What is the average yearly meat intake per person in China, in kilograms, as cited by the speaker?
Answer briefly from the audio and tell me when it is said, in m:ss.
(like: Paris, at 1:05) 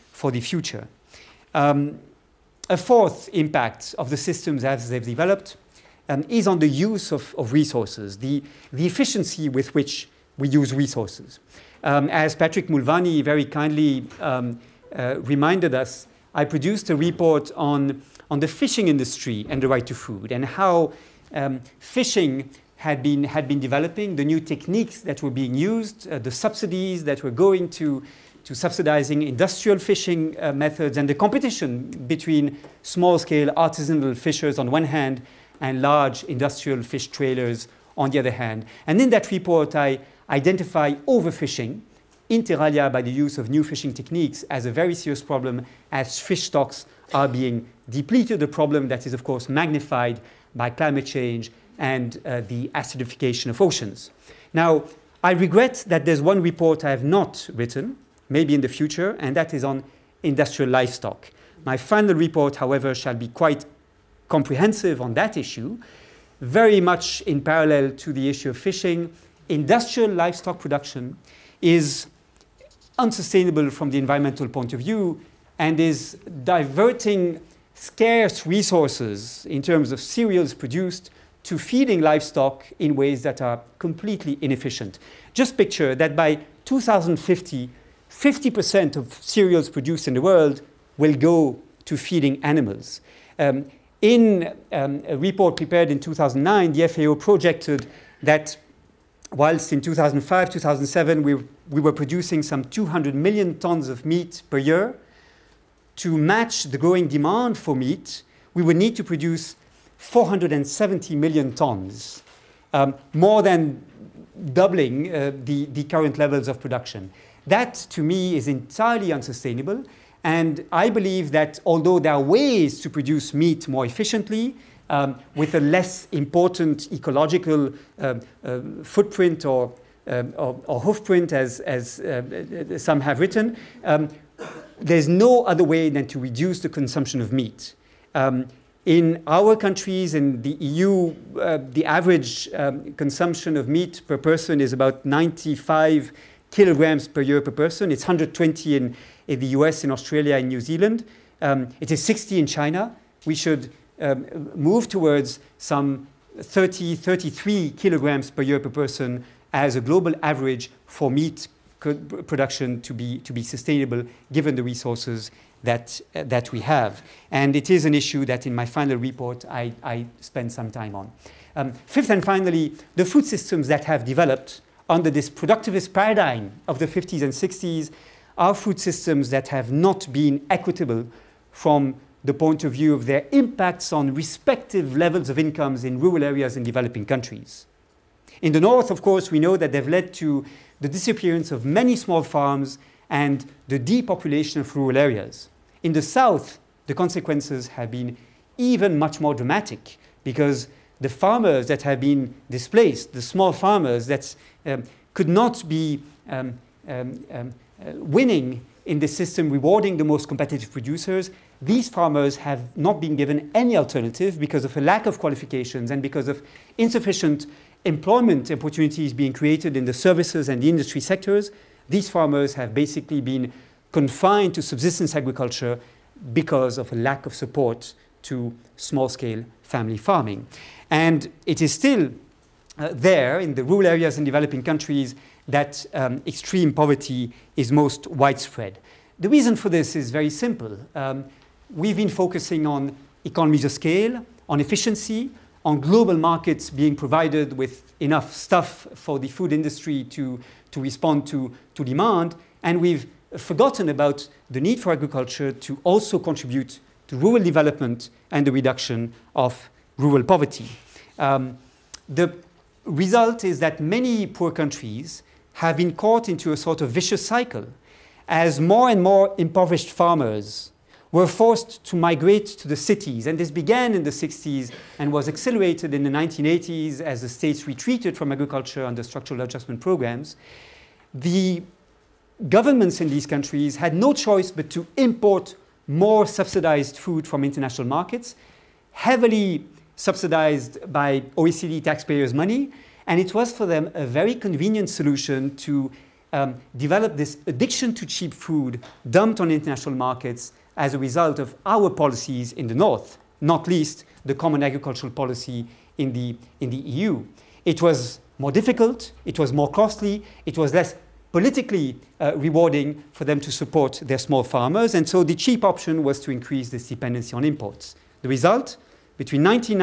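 60, at 2:32.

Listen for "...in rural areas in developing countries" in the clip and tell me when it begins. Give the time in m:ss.
3:05.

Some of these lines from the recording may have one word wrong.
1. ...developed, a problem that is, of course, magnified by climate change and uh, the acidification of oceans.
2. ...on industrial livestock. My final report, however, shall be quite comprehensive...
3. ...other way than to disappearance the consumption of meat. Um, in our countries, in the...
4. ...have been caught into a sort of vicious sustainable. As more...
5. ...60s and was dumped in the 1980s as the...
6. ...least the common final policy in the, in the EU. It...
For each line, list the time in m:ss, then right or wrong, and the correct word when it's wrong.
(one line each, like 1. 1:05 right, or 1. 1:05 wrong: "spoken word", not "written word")
1. 0:47 wrong: "depleted", not "developed"
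2. 0:59 right
3. 2:15 wrong: "reduce", not "disappearance"
4. 4:25 wrong: "cycle", not "sustainable"
5. 4:34 wrong: "accelerated", not "dumped"
6. 5:03 wrong: "agricultural", not "final".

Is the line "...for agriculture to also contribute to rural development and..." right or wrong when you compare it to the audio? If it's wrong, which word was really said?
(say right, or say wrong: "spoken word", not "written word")
right.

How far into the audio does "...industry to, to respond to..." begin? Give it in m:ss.
4:09.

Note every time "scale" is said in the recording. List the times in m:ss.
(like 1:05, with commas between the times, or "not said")
0:32, 3:48, 4:03.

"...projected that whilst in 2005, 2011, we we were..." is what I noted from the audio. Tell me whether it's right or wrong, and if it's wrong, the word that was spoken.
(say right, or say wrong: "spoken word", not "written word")
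wrong: "2007", not "2011".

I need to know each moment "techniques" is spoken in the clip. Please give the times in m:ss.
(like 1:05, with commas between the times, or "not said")
0:24, 0:43.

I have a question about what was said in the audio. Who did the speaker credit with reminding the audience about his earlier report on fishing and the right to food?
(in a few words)
Patrick Mulvaney.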